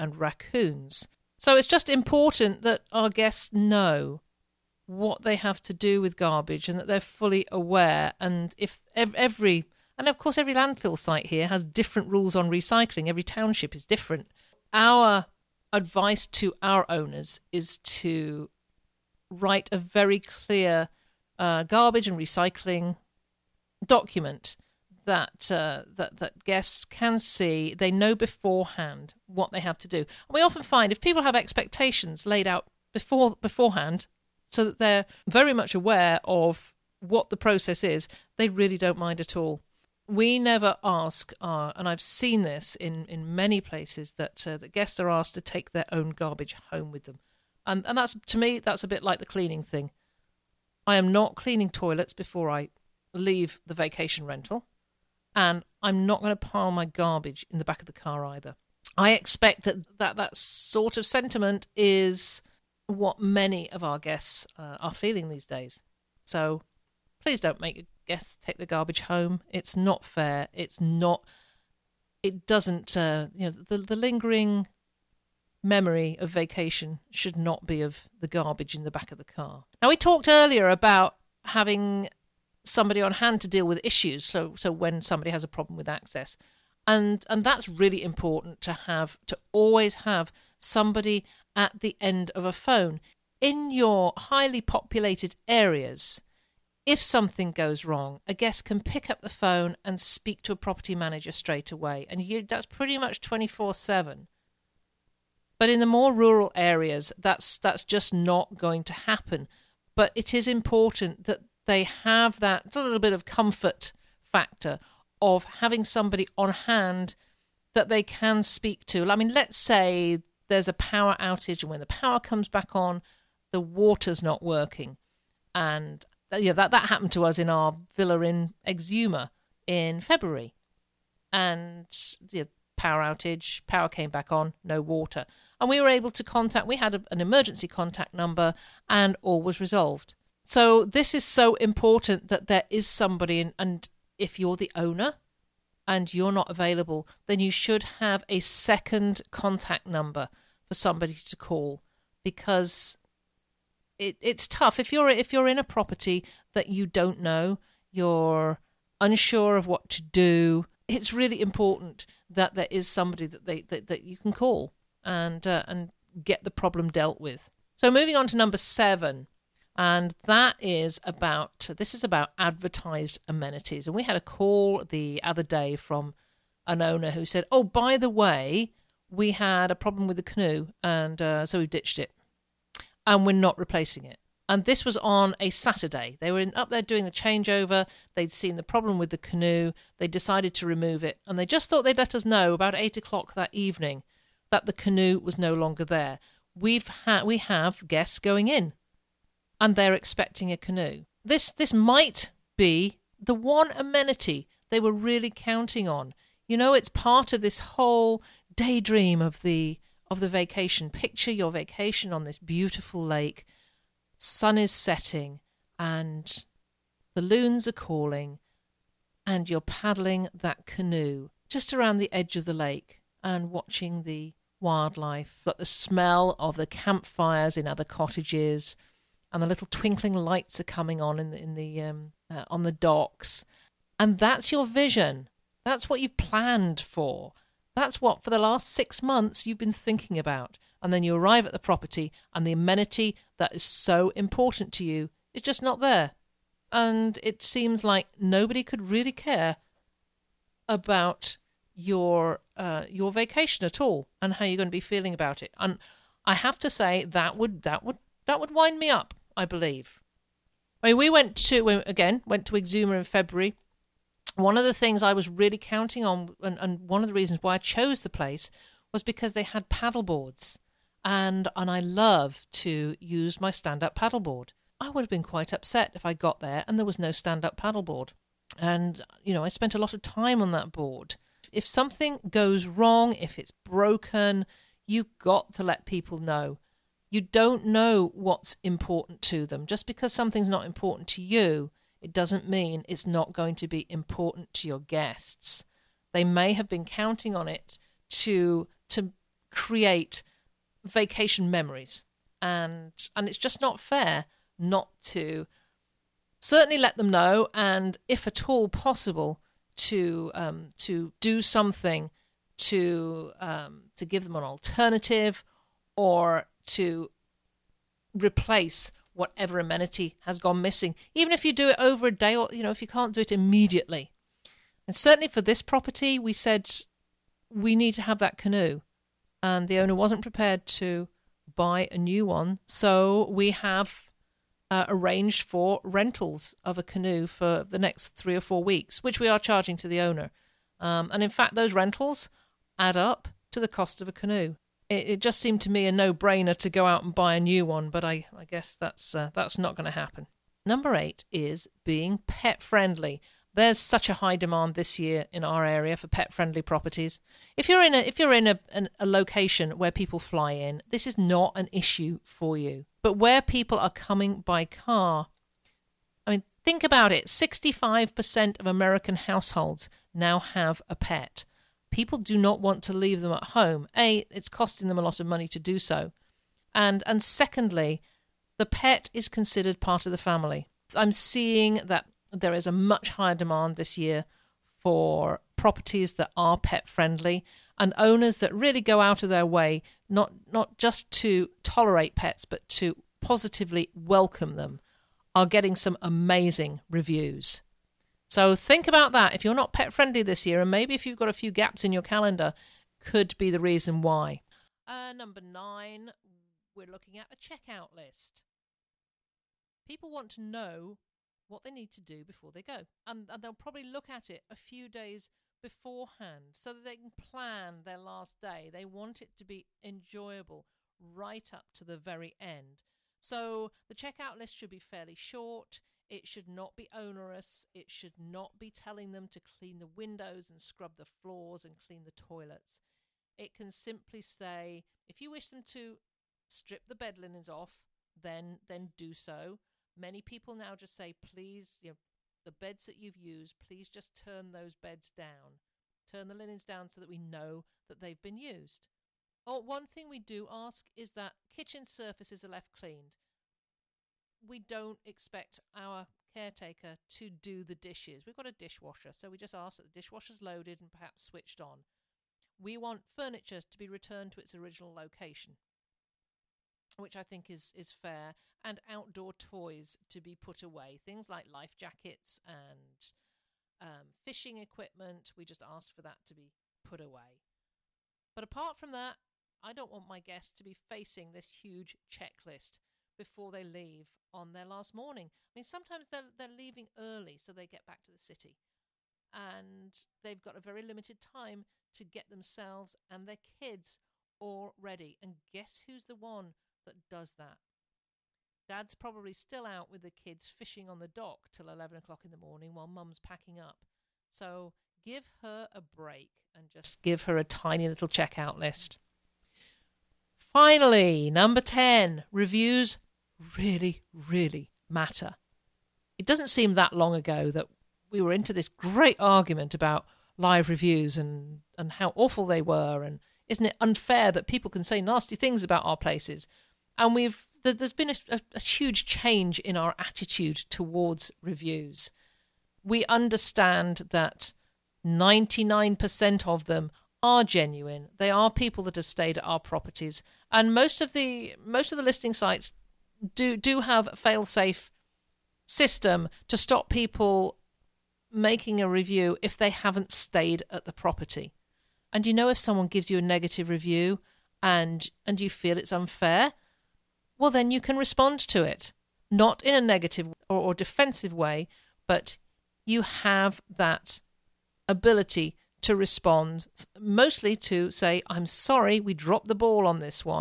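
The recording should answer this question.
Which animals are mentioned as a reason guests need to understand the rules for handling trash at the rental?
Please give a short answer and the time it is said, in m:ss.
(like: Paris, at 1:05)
raccoons, at 0:00.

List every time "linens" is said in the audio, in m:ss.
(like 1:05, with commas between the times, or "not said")
7:17, 7:26.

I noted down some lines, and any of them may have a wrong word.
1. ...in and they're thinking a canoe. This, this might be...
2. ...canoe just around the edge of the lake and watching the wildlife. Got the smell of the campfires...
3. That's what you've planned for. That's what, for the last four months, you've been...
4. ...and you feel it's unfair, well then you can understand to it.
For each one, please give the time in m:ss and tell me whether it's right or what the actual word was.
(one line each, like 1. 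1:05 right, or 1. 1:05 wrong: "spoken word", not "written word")
1. 3:18 wrong: "expecting", not "thinking"
2. 3:40 right
3. 3:55 wrong: "six", not "four"
4. 9:15 wrong: "respond", not "understand".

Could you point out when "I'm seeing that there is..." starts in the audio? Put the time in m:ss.
6:20.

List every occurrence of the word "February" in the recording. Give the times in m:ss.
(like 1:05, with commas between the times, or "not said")
2:09, 4:23.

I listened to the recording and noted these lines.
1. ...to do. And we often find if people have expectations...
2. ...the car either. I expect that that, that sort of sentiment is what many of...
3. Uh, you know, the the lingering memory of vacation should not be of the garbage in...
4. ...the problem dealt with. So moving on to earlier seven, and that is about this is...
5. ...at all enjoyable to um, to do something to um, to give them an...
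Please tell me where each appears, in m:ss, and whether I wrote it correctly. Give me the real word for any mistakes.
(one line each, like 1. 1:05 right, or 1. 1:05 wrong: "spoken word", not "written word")
1. 0:29 right
2. 0:57 right
3. 1:12 right
4. 2:46 wrong: "number", not "earlier"
5. 5:08 wrong: "possible", not "enjoyable".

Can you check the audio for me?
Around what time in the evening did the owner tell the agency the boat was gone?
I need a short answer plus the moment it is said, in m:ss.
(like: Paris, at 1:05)
8 o'clock, at 3:12.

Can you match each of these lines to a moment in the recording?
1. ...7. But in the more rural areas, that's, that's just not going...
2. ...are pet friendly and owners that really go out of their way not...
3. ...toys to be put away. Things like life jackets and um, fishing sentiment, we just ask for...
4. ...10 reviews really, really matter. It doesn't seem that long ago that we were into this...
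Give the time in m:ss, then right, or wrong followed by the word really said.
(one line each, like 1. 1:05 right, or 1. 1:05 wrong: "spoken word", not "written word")
1. 1:43 right
2. 6:26 right
3. 7:49 wrong: "equipment", not "sentiment"
4. 8:31 right.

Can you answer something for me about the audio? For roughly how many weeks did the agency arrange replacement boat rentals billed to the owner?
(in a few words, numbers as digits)
3 or 4 weeks.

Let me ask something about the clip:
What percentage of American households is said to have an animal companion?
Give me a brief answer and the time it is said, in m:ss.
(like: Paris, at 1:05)
65%, at 6:07.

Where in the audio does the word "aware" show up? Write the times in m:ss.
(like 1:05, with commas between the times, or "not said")
0:07, 0:35.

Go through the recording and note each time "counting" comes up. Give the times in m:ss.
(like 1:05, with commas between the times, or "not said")
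3:25, 4:25, 4:56.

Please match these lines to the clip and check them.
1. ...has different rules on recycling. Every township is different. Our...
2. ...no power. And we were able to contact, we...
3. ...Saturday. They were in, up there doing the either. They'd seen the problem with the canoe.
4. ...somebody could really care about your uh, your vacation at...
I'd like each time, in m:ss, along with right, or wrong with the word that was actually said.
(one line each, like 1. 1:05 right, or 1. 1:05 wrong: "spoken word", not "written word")
1. 0:11 right
2. 2:14 wrong: "water", not "power"
3. 3:05 wrong: "changeover", not "either"
4. 4:08 wrong: "nobody", not "somebody".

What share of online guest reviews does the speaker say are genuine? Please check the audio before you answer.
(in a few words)
99%.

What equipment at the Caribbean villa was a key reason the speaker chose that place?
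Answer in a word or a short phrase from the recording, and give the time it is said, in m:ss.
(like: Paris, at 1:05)
paddle boards, at 4:29.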